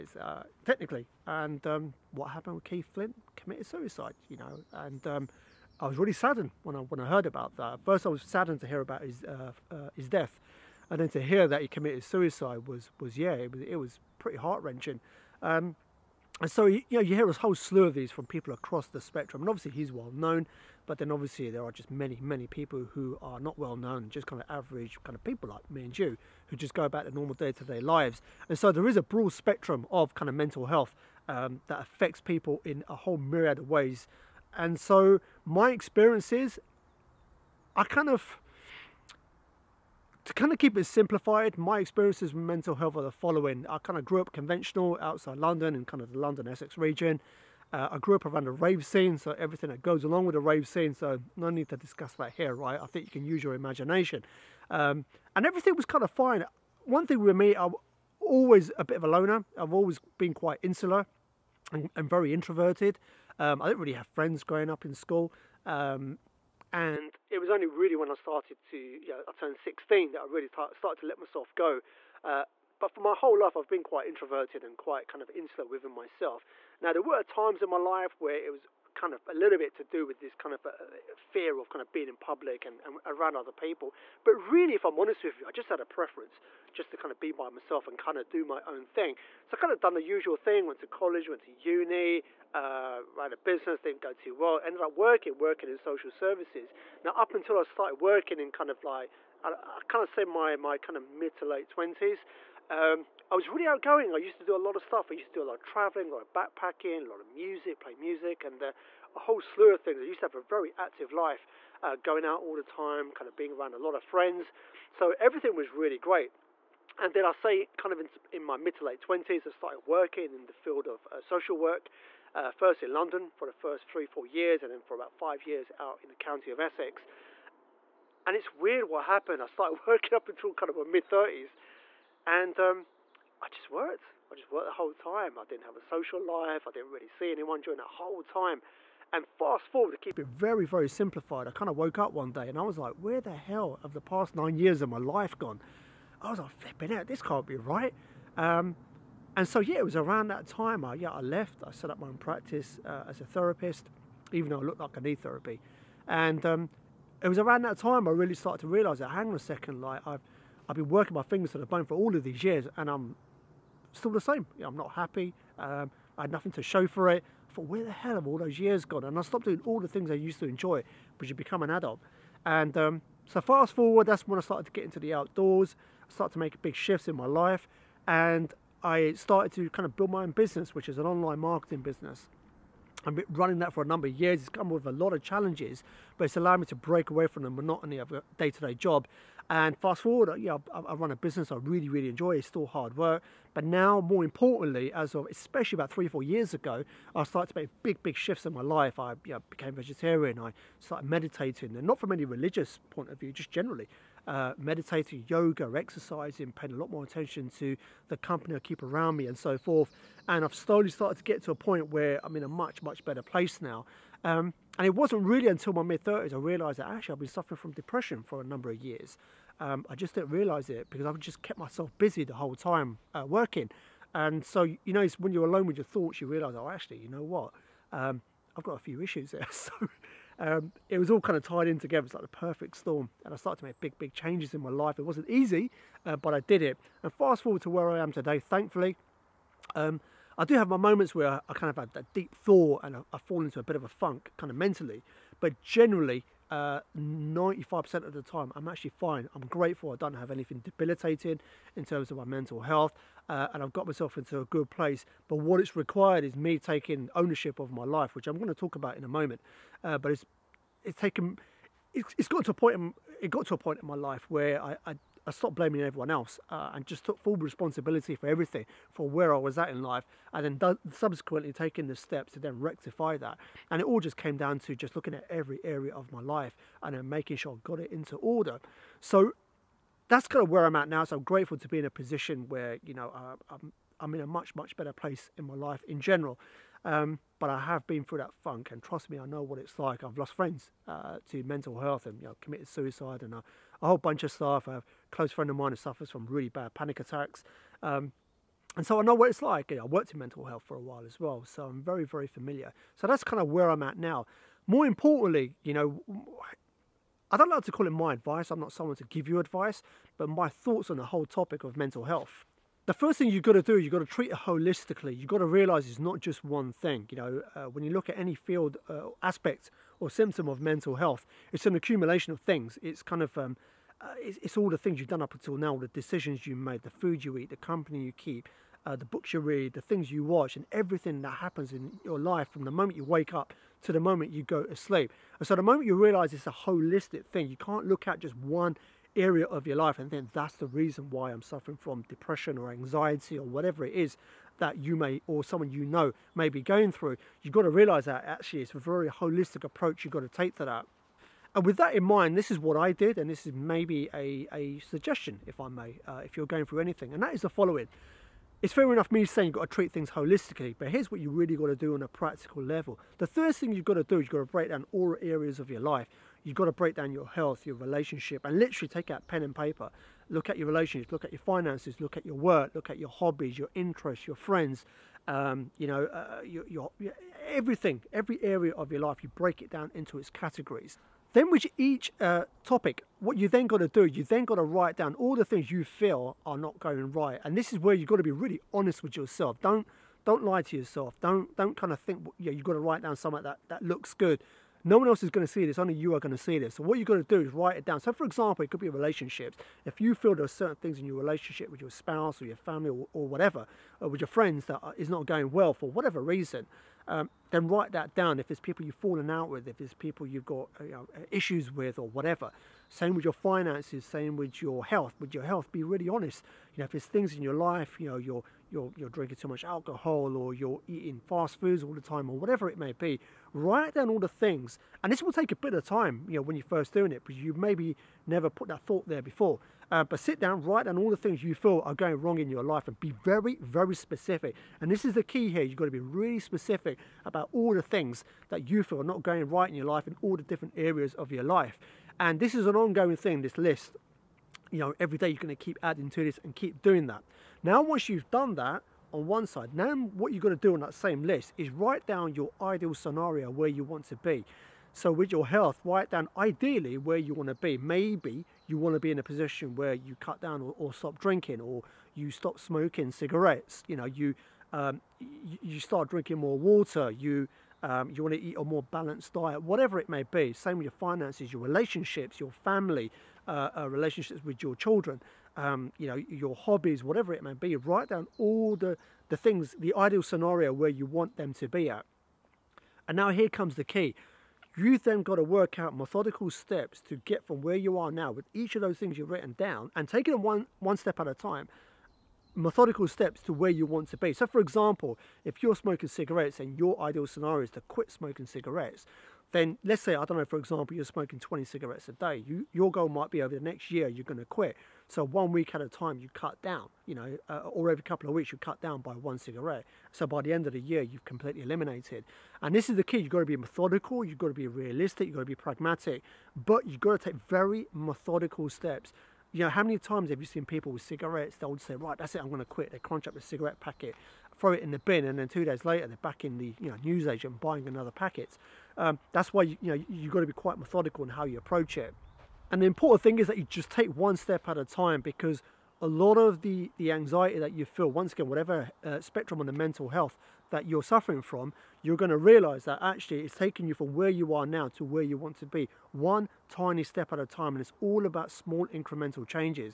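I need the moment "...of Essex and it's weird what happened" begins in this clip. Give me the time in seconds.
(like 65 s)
126 s.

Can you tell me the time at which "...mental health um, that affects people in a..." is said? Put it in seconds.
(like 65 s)
30 s.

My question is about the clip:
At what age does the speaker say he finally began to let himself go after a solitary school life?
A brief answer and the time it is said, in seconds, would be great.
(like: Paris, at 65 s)
16, at 69 s.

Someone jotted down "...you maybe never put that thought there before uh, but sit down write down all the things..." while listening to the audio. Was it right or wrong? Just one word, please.
right.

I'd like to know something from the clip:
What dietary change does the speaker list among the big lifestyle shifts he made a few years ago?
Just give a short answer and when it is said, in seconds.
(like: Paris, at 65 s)
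Became vegetarian, at 199 s.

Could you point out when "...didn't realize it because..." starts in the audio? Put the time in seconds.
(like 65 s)
220 s.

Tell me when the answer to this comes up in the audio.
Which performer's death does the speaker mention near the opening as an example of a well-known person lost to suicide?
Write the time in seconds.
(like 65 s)
2 s.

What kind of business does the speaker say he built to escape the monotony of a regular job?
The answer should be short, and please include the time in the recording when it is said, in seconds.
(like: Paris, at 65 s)
Online marketing, at 181 s.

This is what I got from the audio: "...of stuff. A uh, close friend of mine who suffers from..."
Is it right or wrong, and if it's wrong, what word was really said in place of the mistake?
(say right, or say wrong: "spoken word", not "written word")
right.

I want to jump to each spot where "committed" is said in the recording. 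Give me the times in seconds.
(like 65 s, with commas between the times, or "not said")
3 s, 11 s, 292 s.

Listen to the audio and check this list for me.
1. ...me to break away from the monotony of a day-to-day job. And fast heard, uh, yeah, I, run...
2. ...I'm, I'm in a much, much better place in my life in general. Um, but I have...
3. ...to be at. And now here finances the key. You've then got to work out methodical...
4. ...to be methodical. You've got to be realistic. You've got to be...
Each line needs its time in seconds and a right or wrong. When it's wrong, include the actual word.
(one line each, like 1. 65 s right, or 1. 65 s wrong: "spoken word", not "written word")
1. 186 s wrong: "forward", not "heard"
2. 283 s right
3. 481 s wrong: "comes", not "finances"
4. 513 s right.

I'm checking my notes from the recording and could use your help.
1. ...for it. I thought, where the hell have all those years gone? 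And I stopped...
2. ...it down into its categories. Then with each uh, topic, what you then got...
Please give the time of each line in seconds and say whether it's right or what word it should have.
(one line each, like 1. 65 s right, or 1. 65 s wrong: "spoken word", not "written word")
1. 166 s right
2. 379 s right.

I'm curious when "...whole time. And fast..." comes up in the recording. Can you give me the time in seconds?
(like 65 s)
137 s.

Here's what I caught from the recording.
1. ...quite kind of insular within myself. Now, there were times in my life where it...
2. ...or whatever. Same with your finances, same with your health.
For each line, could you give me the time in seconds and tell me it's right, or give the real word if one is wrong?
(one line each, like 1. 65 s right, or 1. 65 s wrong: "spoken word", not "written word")
1. 74 s right
2. 411 s right.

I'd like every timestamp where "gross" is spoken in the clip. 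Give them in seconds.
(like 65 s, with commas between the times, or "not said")
not said.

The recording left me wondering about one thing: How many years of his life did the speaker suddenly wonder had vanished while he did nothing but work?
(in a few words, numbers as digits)
9.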